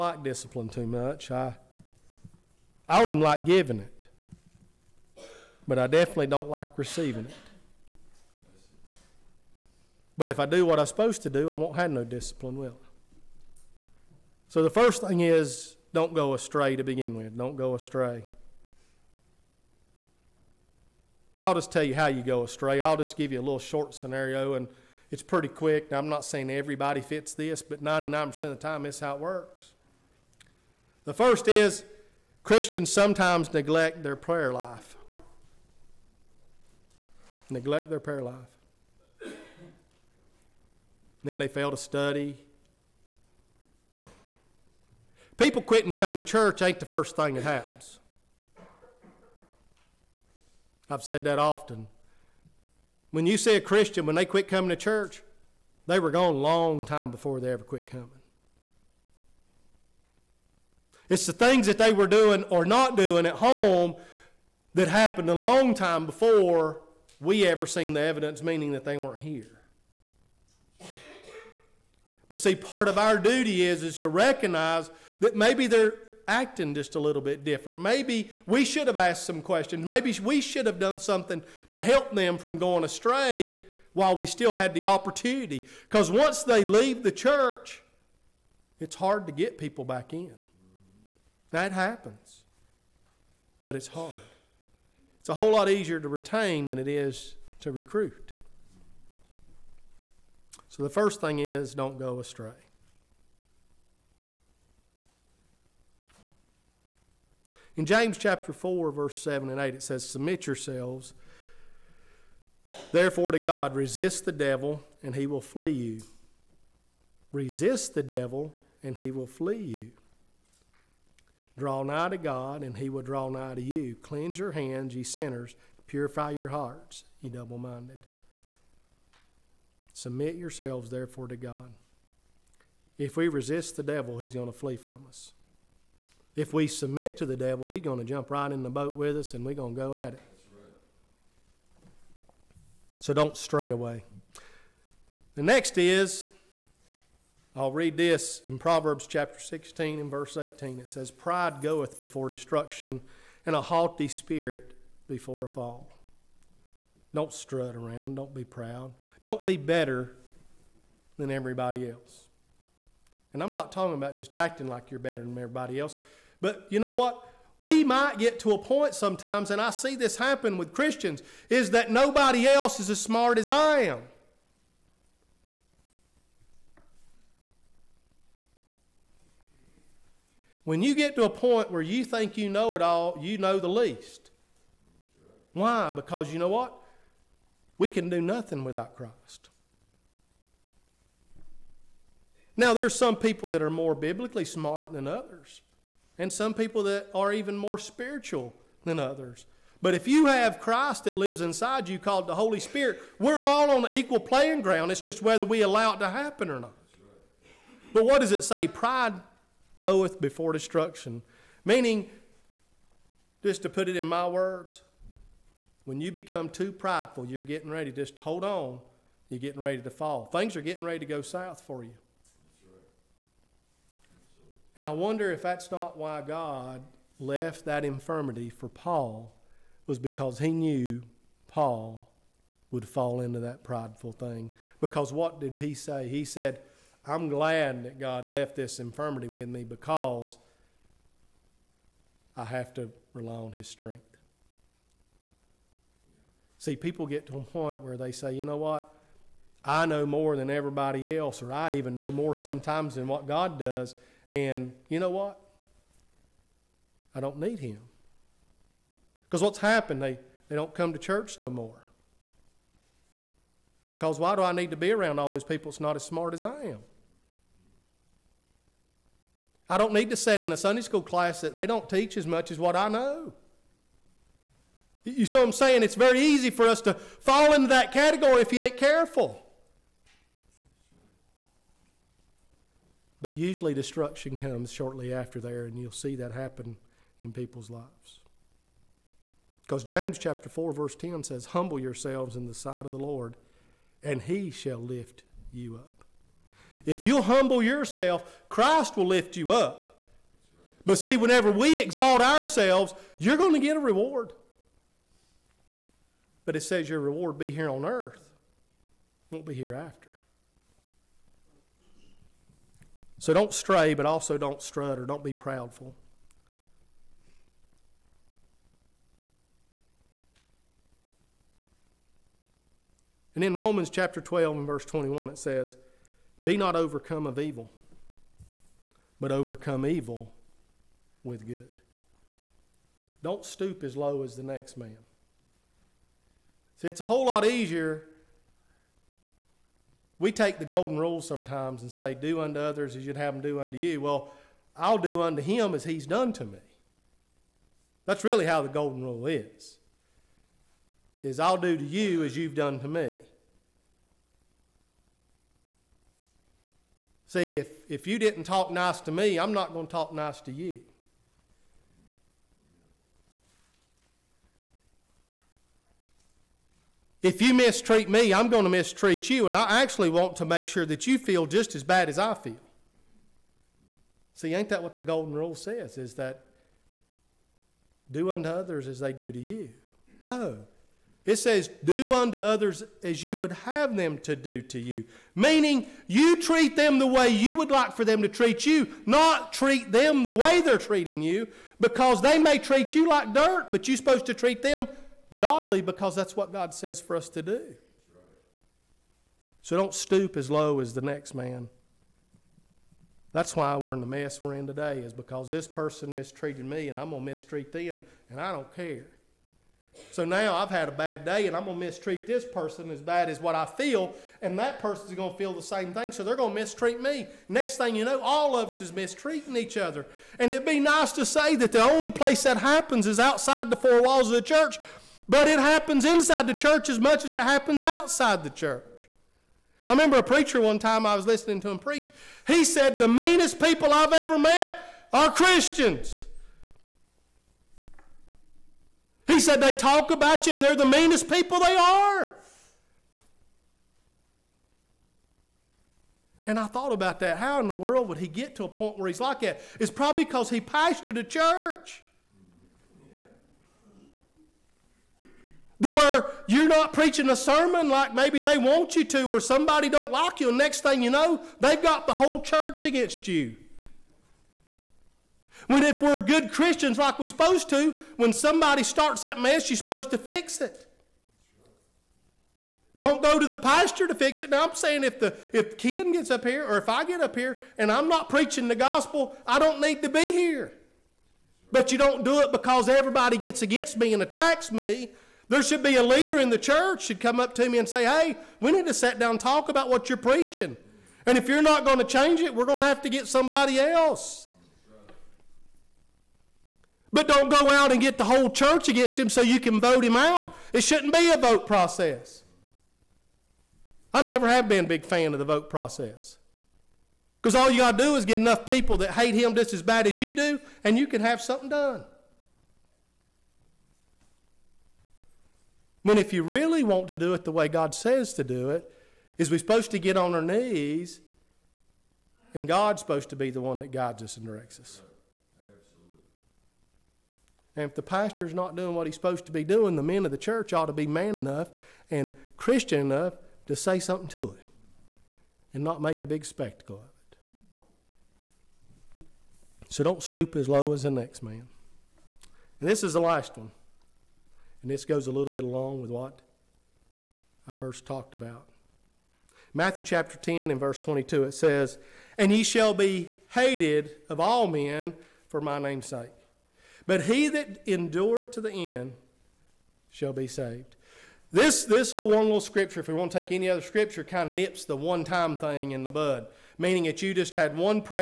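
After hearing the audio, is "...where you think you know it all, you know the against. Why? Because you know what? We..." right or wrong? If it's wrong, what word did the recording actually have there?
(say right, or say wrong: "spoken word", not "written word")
wrong: "least", not "against".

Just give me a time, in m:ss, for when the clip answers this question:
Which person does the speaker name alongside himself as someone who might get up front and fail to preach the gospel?
7:55.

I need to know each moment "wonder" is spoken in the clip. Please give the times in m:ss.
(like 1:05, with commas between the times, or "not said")
3:44.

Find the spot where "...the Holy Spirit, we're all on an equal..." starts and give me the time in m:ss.
3:22.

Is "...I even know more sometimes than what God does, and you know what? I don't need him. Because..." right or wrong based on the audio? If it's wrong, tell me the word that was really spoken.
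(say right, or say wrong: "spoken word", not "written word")
right.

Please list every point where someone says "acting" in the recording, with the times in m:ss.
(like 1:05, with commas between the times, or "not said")
1:16, 2:44.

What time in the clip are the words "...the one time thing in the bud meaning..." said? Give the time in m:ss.
9:24.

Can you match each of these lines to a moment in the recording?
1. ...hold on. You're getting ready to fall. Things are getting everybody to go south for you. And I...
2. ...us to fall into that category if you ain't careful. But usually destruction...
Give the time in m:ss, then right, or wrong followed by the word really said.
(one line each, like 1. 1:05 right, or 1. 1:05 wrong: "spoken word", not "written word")
1. 3:38 wrong: "ready", not "everybody"
2. 4:36 right.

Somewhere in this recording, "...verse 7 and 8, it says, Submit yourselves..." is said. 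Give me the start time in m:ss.
1:48.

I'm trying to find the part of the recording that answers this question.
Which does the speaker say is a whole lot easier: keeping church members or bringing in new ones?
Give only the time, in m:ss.
1:36.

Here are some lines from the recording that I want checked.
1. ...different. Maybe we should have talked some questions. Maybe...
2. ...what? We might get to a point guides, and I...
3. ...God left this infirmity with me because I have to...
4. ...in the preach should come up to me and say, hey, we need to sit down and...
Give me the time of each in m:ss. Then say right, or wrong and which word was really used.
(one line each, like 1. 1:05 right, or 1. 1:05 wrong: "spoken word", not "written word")
1. 1:17 wrong: "asked", not "talked"
2. 2:46 wrong: "sometimes", not "guides"
3. 3:57 right
4. 8:06 wrong: "church", not "preach".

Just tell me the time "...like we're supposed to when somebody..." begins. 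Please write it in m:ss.
7:46.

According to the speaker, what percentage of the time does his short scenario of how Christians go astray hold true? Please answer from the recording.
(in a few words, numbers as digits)
99%.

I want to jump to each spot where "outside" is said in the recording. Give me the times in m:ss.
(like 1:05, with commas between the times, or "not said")
7:03, 7:07.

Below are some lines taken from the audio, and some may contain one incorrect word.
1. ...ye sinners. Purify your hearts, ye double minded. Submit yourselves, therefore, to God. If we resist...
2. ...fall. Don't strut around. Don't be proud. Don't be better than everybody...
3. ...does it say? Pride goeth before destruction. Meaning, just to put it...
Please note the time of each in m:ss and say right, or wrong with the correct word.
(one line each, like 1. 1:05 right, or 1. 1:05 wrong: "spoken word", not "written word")
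1. 2:04 right
2. 2:35 right
3. 3:28 right.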